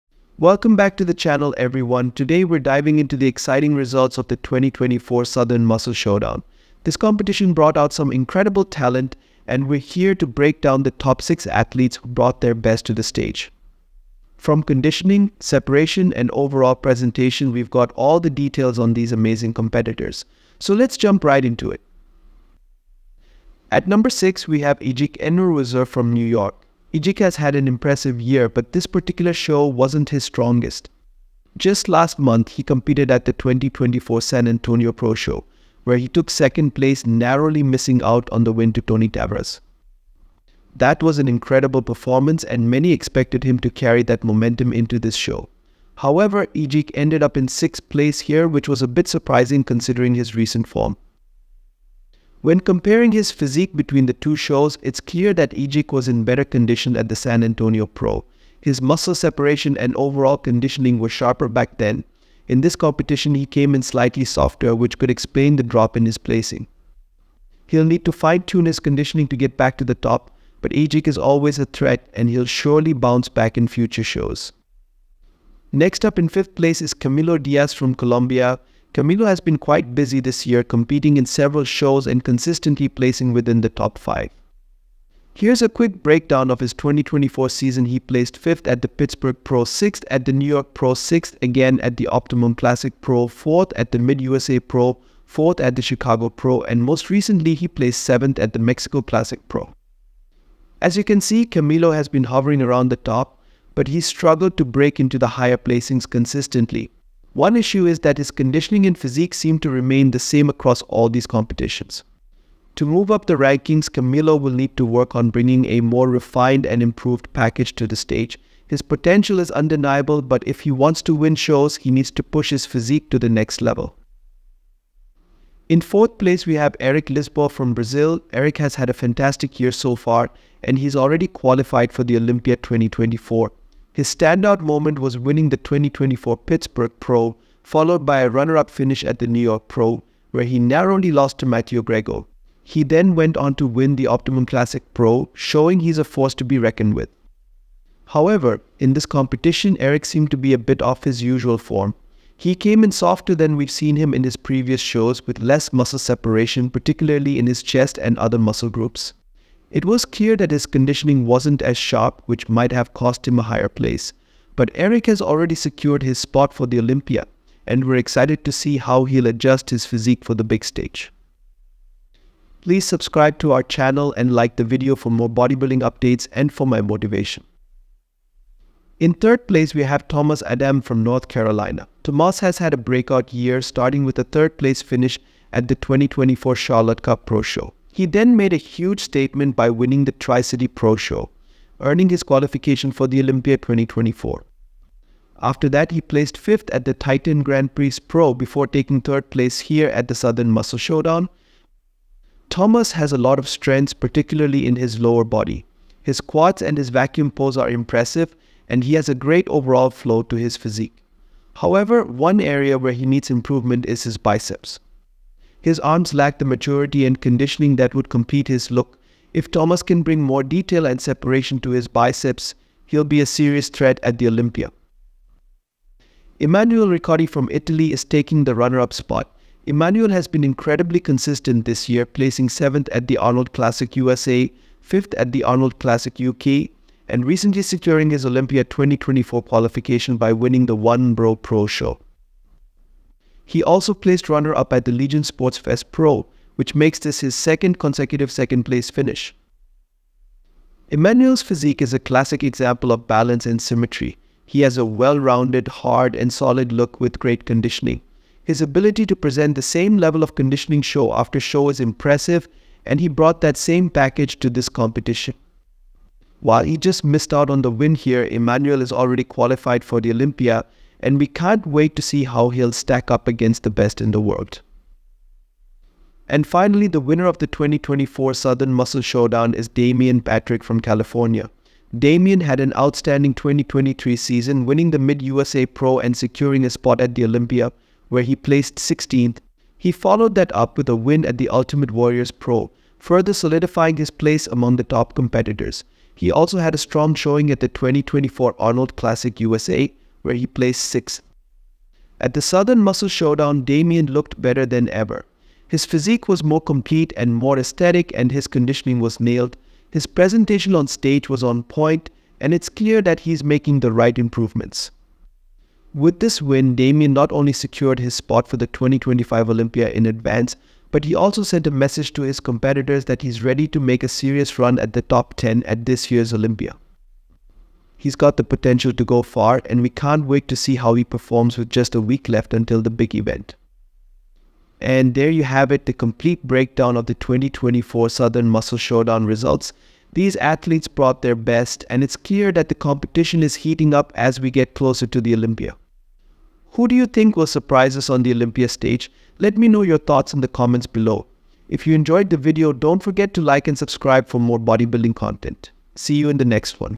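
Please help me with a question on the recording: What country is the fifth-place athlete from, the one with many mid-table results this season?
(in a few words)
Colombia.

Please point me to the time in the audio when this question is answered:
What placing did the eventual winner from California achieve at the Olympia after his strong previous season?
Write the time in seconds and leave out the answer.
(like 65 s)
288 s.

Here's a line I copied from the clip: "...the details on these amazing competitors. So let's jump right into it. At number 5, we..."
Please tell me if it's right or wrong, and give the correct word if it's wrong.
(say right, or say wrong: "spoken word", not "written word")
wrong: "6", not "5".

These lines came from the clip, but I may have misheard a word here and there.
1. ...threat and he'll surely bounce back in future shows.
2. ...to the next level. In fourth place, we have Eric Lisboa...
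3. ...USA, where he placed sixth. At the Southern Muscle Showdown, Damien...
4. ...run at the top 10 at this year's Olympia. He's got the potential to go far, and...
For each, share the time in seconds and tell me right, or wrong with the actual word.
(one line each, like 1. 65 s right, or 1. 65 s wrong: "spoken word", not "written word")
1. 71 s right
2. 123 s right
3. 299 s right
4. 324 s right.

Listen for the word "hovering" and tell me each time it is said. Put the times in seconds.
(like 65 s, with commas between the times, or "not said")
102 s.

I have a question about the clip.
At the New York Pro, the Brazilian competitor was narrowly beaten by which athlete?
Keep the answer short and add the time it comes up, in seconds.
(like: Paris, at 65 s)
Matteo Grego, at 141 s.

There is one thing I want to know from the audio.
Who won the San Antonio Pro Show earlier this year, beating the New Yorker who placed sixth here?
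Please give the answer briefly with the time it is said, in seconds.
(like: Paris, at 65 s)
Tony Tavares, at 38 s.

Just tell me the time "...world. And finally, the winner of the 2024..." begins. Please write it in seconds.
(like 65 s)
274 s.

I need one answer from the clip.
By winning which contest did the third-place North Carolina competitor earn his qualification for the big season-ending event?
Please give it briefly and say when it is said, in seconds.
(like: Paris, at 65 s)
Tri City Pro Show, at 190 s.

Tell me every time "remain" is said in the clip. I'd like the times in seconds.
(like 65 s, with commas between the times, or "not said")
109 s.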